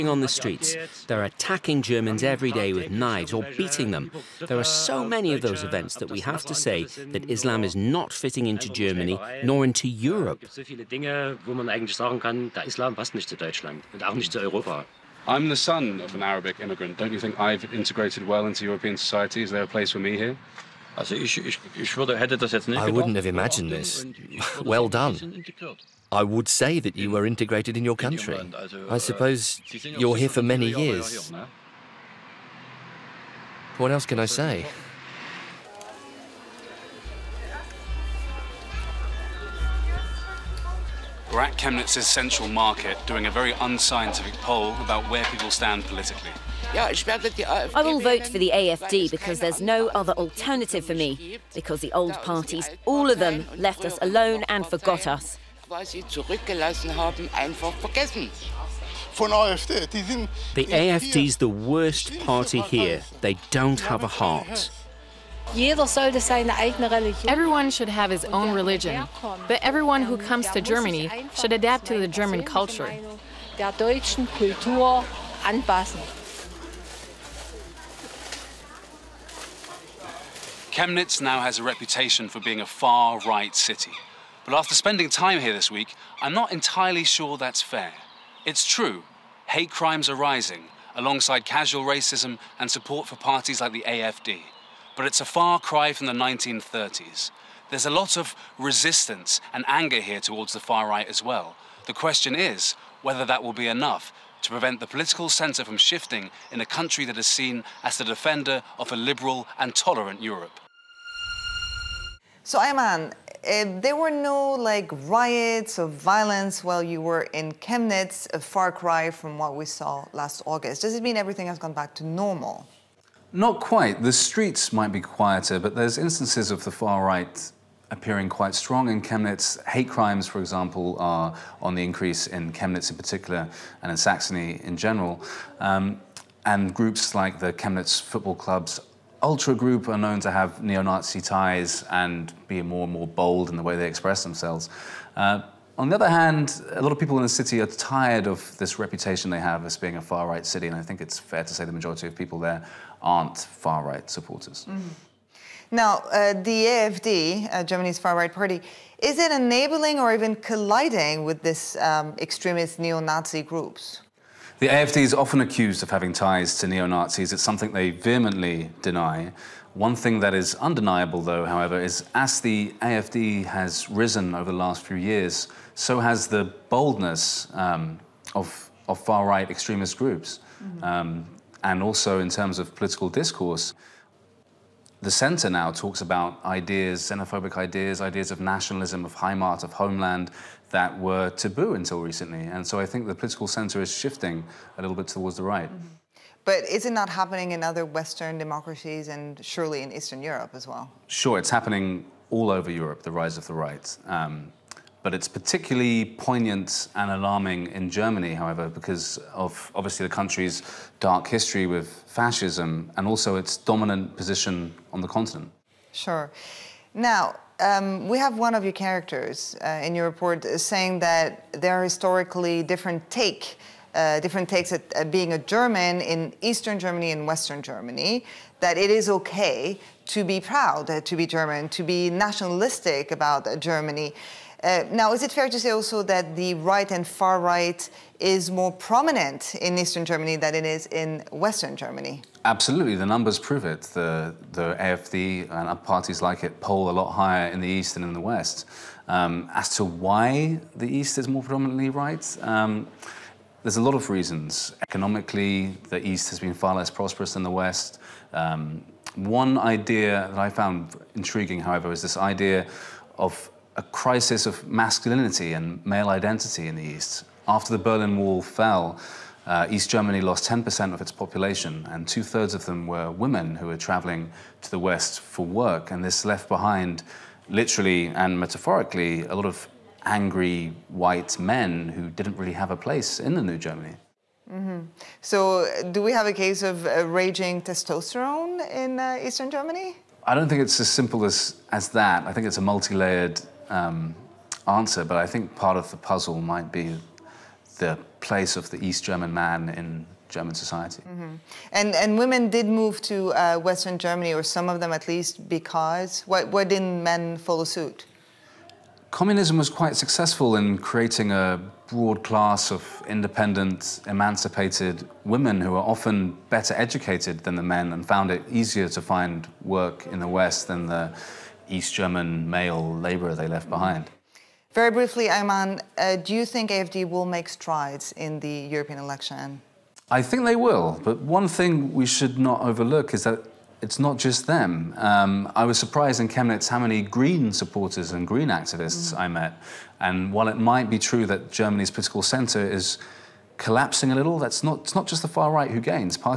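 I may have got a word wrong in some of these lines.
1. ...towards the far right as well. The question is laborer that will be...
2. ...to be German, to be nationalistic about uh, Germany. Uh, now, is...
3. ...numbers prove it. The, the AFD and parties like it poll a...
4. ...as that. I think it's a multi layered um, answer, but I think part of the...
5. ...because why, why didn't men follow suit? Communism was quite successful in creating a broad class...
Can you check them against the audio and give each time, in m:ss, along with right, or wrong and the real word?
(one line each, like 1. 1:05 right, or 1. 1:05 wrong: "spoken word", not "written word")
1. 1:40 wrong: "whether", not "laborer"
2. 3:51 right
3. 4:03 right
4. 4:51 right
5. 5:05 right.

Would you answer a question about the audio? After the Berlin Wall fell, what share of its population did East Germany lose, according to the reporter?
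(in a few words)
10%.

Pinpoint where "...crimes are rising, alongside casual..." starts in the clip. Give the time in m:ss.
1:29.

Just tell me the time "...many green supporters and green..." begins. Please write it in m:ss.
5:36.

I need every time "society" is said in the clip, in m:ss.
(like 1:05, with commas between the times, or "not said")
0:18, 5:00.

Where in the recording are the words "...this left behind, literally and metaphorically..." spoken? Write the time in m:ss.
4:36.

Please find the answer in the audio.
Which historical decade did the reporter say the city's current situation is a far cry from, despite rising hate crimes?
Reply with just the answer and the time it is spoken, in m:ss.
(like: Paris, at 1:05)
1930s, at 1:36.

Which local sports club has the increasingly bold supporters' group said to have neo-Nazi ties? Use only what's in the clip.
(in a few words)
Chemnitz Football Club.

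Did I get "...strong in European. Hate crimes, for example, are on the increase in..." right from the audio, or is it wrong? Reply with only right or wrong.
wrong.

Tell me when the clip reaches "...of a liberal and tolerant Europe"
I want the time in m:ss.
1:48.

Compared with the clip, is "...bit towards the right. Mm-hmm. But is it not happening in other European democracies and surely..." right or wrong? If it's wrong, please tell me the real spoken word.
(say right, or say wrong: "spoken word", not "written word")
wrong: "Western", not "European".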